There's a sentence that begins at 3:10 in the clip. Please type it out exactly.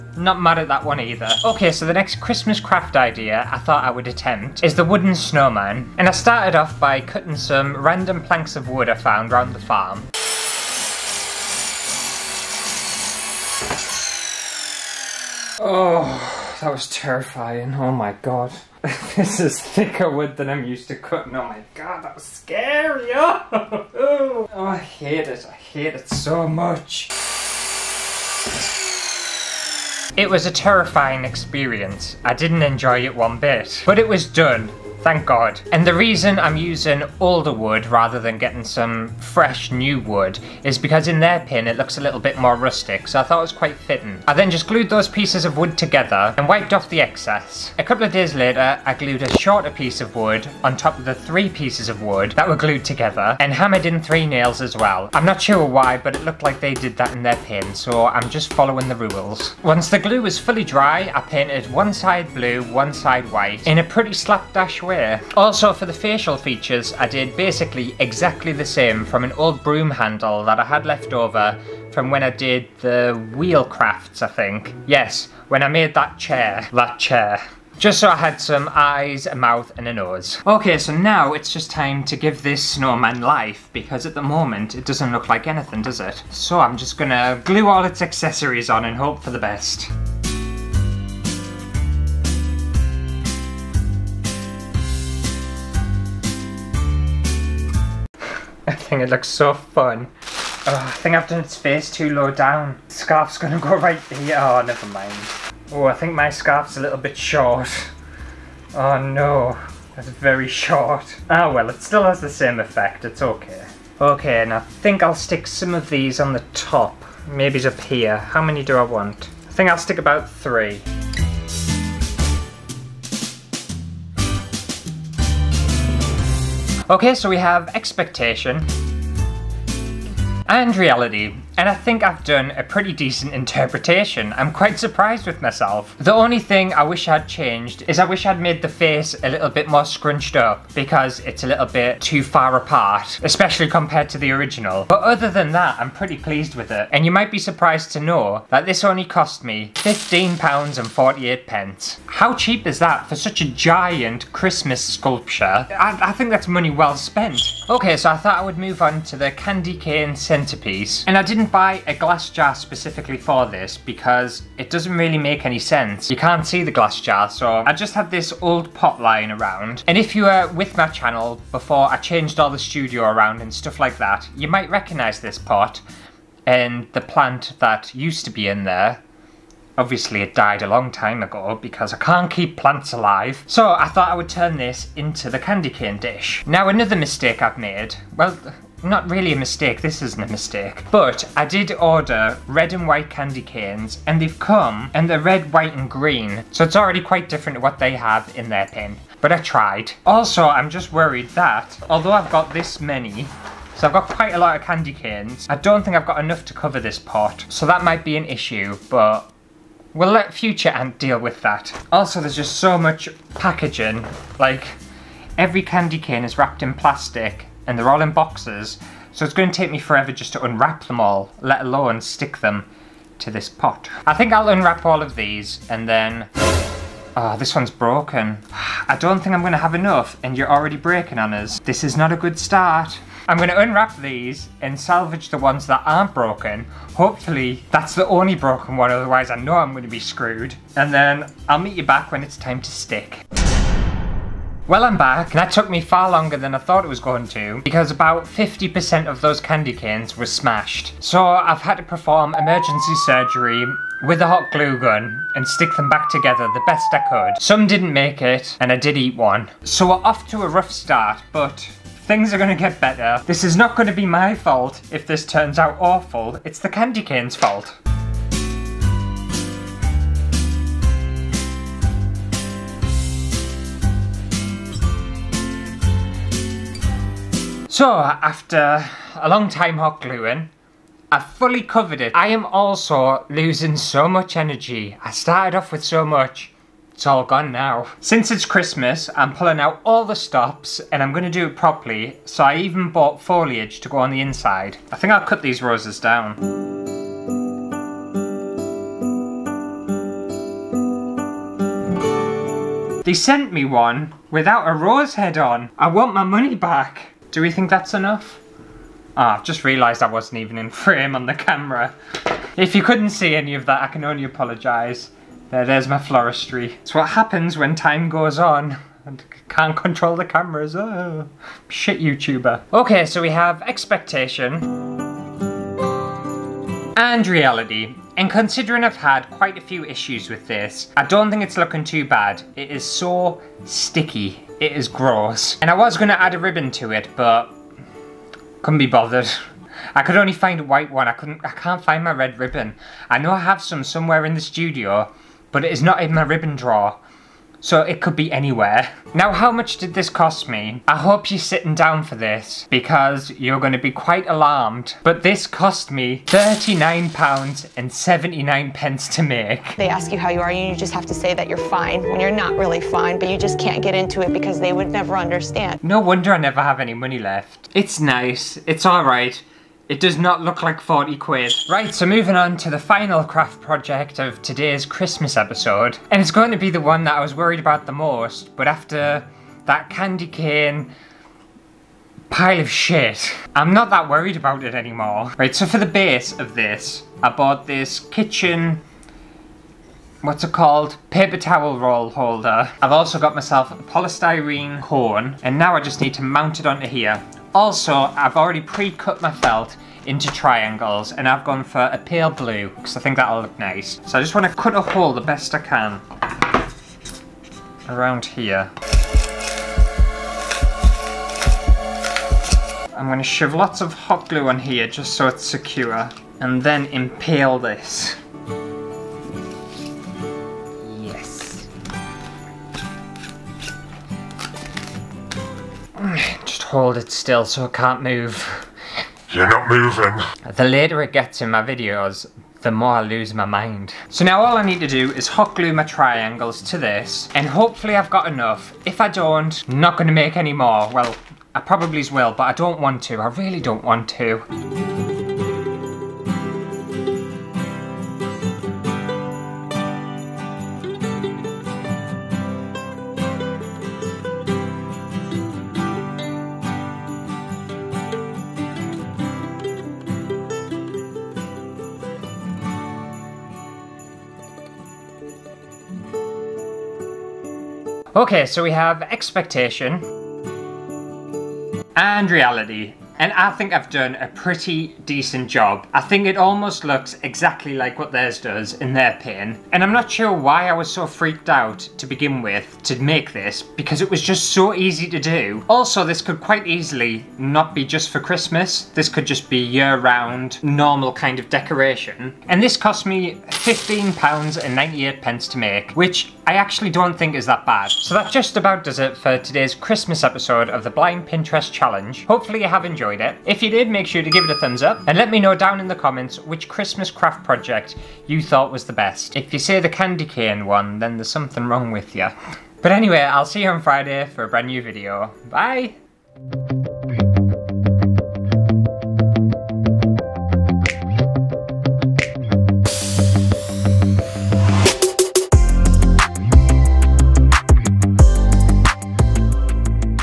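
But I did order red and white candy canes and they've come and they're red, white and green.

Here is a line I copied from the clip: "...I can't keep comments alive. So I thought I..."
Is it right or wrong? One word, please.
wrong.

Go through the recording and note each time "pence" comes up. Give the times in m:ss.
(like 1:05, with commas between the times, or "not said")
2:31, 5:58.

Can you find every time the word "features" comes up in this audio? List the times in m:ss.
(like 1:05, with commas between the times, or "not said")
1:06.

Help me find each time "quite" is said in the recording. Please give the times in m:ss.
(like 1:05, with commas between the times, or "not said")
0:43, 2:14, 3:16, 3:24, 5:29, 5:53, 8:06.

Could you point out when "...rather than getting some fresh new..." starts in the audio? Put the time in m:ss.
0:37.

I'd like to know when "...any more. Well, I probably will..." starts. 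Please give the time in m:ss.
7:20.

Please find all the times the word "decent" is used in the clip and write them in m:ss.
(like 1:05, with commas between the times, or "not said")
2:12, 7:55.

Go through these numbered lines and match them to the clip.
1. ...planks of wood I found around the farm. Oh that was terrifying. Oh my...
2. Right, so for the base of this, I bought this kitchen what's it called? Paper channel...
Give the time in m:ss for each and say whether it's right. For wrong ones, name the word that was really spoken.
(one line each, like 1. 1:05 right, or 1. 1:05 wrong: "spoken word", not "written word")
1. 0:08 right
2. 6:25 wrong: "towel", not "channel".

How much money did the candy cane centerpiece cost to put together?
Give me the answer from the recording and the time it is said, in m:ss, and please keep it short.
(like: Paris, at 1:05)
£39.79, at 5:56.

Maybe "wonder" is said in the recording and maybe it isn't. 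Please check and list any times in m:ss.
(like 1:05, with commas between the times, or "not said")
6:05.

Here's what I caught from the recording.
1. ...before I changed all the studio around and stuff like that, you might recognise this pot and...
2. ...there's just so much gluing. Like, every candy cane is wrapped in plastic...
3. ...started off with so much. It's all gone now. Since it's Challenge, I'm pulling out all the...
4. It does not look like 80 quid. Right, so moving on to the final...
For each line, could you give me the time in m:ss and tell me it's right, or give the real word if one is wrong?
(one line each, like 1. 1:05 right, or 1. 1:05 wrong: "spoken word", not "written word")
1. 2:51 right
2. 3:32 wrong: "packaging", not "gluing"
3. 4:45 wrong: "Christmas", not "Challenge"
4. 6:09 wrong: "40", not "80".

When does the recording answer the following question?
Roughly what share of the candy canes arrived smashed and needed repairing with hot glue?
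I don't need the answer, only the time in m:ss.
4:08.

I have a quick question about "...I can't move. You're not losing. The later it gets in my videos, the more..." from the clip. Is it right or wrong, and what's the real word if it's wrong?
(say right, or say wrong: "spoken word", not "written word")
wrong: "moving", not "losing".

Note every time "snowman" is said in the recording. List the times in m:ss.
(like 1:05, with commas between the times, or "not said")
0:05, 1:22.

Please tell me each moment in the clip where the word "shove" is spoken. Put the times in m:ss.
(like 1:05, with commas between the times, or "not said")
6:53.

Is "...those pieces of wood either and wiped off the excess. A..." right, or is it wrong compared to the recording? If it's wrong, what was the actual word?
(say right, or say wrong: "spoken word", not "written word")
wrong: "together", not "either".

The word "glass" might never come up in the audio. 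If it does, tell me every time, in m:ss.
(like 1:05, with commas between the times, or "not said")
2:41, 2:46.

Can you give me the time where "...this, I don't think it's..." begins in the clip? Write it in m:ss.
5:30.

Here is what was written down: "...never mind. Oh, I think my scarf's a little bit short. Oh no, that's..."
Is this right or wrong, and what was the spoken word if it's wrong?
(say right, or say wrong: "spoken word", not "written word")
right.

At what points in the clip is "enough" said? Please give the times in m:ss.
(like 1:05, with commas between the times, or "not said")
3:26, 3:49, 5:07, 7:18.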